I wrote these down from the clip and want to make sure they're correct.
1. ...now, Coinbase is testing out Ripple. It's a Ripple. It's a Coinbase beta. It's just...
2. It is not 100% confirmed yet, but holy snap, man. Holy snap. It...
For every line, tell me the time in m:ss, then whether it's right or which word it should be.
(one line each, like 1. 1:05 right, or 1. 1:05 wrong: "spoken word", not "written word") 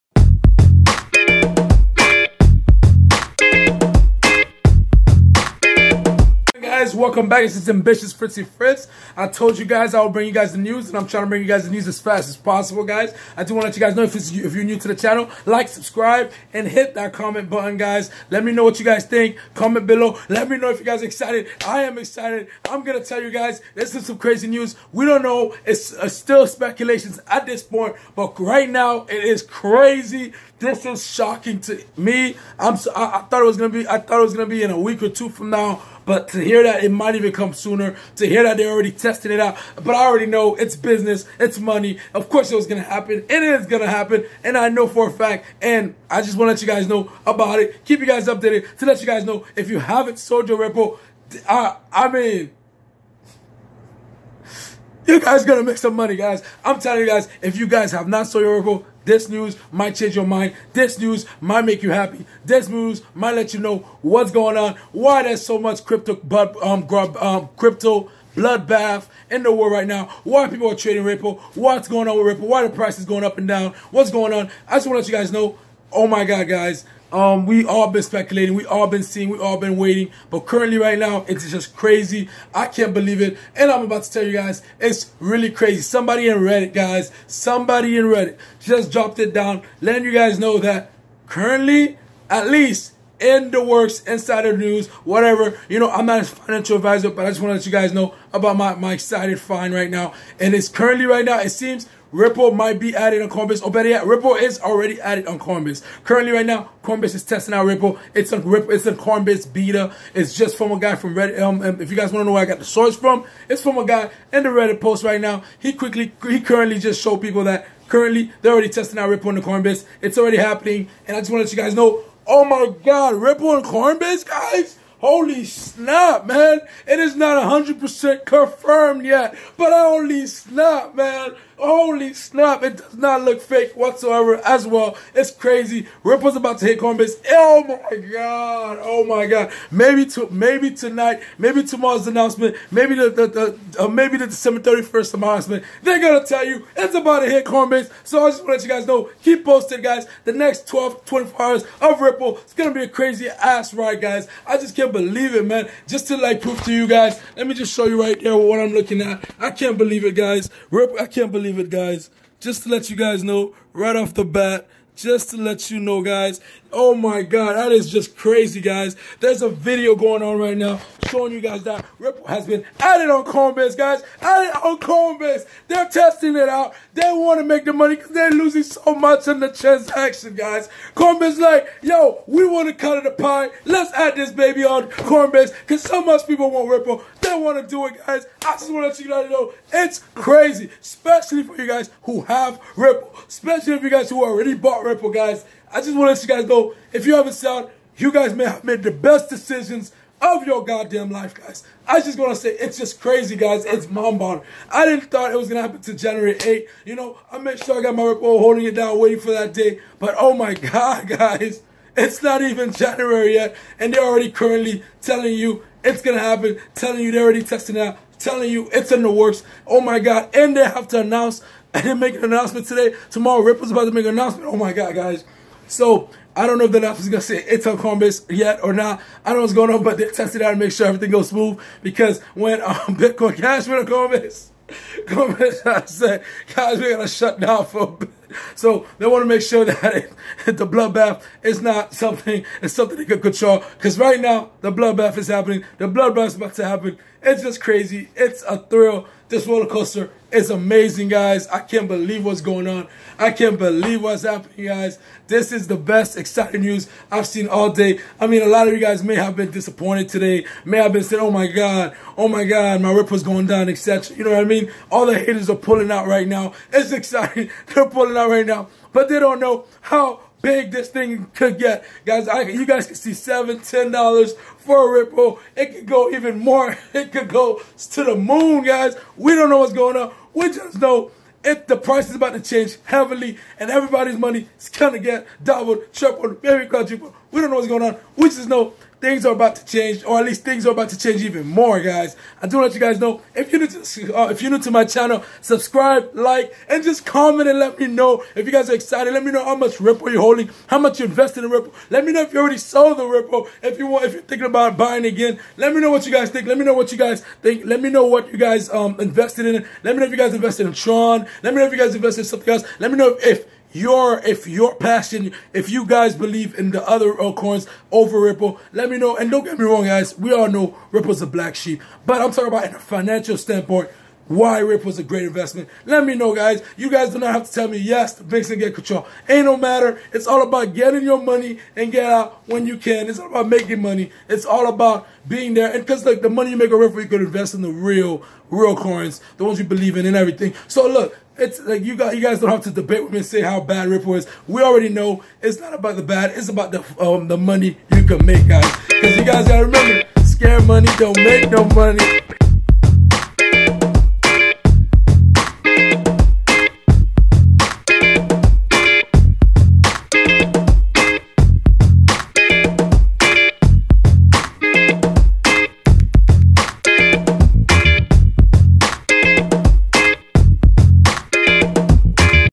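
1. 1:46 right
2. 2:06 right.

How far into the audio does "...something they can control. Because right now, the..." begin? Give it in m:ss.
4:02.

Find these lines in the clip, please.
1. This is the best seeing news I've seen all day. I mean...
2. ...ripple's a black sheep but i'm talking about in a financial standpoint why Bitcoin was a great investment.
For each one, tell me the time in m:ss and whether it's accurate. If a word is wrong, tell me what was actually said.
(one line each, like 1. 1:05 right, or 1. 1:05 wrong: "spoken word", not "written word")
1. 4:15 wrong: "exciting", not "seeing"
2. 5:20 wrong: "Rip", not "Bitcoin".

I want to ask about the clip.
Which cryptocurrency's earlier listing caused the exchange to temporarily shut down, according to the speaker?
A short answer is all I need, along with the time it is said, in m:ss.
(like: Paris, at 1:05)
Bitcoin Cash, at 3:52.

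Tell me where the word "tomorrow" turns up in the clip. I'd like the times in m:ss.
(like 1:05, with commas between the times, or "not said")
2:21, 3:43.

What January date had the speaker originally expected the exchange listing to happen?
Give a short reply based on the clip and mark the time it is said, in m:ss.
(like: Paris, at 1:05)
January 8, at 3:25.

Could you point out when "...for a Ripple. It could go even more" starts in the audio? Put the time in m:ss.
4:34.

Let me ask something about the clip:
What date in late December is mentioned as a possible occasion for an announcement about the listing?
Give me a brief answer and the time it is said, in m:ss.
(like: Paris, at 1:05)
December 31st, at 2:24.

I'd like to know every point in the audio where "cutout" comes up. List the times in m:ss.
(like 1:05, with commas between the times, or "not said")
not said.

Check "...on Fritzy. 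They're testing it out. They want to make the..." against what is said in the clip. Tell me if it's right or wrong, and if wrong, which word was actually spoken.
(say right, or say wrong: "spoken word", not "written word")
wrong: "Coinbase", not "Fritzy".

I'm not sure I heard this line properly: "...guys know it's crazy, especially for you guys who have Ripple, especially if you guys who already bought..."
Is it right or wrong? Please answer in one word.
right.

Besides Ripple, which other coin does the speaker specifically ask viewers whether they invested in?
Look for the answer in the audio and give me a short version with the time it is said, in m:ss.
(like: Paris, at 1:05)
Tron, at 5:10.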